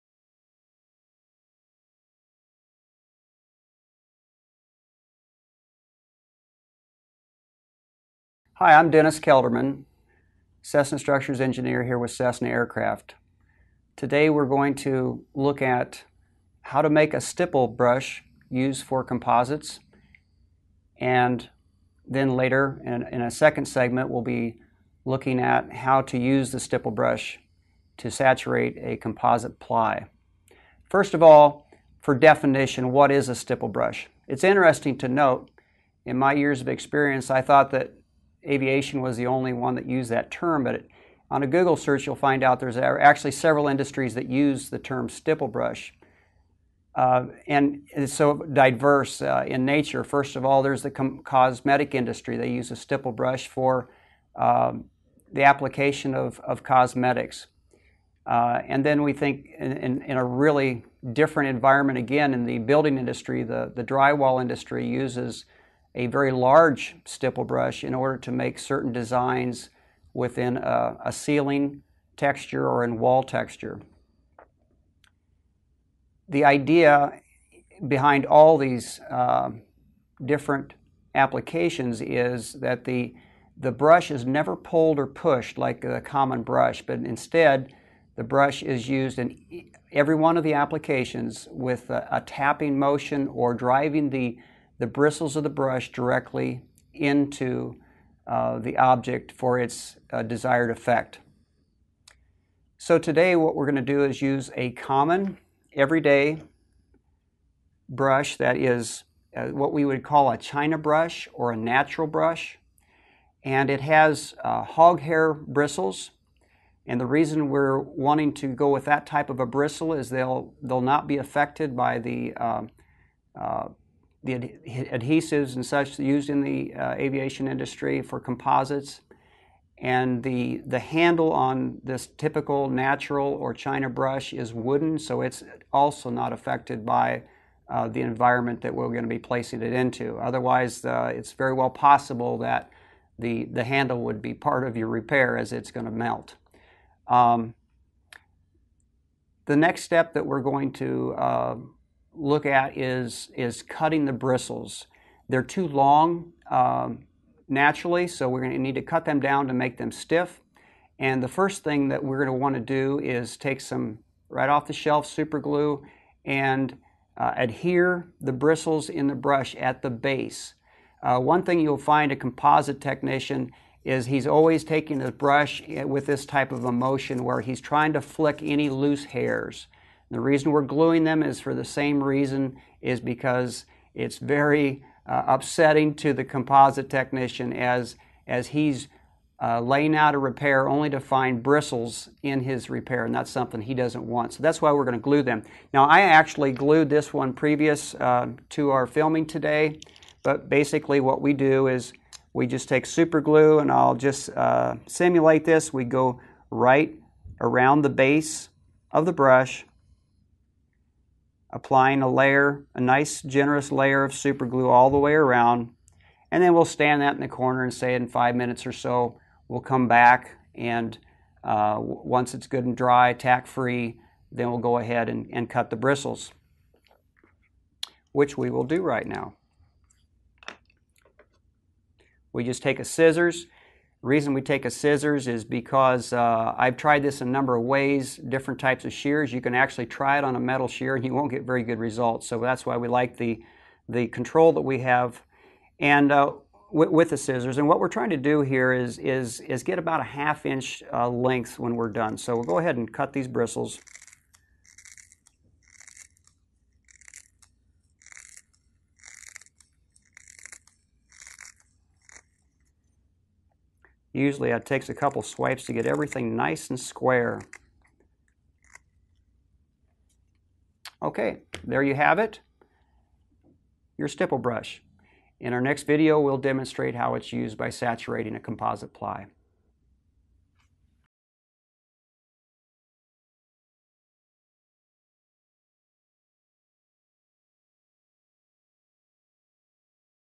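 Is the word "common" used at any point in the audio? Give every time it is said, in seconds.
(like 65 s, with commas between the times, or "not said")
85 s, 104 s.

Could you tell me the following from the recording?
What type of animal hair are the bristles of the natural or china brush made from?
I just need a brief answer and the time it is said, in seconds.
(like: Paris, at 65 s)
Hog hair, at 114 s.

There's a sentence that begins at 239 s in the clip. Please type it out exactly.
You can actually try it on a metal shear and you won't get very good results.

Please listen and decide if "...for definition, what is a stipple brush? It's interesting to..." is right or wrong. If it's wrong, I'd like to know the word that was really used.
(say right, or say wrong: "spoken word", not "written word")
right.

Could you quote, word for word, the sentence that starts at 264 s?
Usually it takes a couple swipes to get everything nice and square.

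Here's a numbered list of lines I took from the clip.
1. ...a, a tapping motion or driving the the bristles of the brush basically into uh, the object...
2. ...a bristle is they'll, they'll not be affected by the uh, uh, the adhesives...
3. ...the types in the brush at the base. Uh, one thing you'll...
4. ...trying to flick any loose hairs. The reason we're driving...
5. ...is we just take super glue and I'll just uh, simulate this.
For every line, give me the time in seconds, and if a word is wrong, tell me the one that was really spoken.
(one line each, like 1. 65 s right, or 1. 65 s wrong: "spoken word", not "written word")
1. 91 s wrong: "directly", not "basically"
2. 119 s right
3. 168 s wrong: "bristles", not "types"
4. 177 s wrong: "gluing", not "driving"
5. 201 s right.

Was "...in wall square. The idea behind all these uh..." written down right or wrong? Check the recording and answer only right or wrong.
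wrong.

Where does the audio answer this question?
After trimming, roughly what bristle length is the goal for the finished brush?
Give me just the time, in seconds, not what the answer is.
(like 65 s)
250 s.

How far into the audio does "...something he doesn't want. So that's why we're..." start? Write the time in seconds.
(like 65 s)
193 s.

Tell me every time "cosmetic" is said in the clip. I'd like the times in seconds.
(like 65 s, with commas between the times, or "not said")
51 s, 56 s.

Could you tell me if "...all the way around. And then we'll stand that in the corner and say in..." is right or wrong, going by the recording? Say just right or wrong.
right.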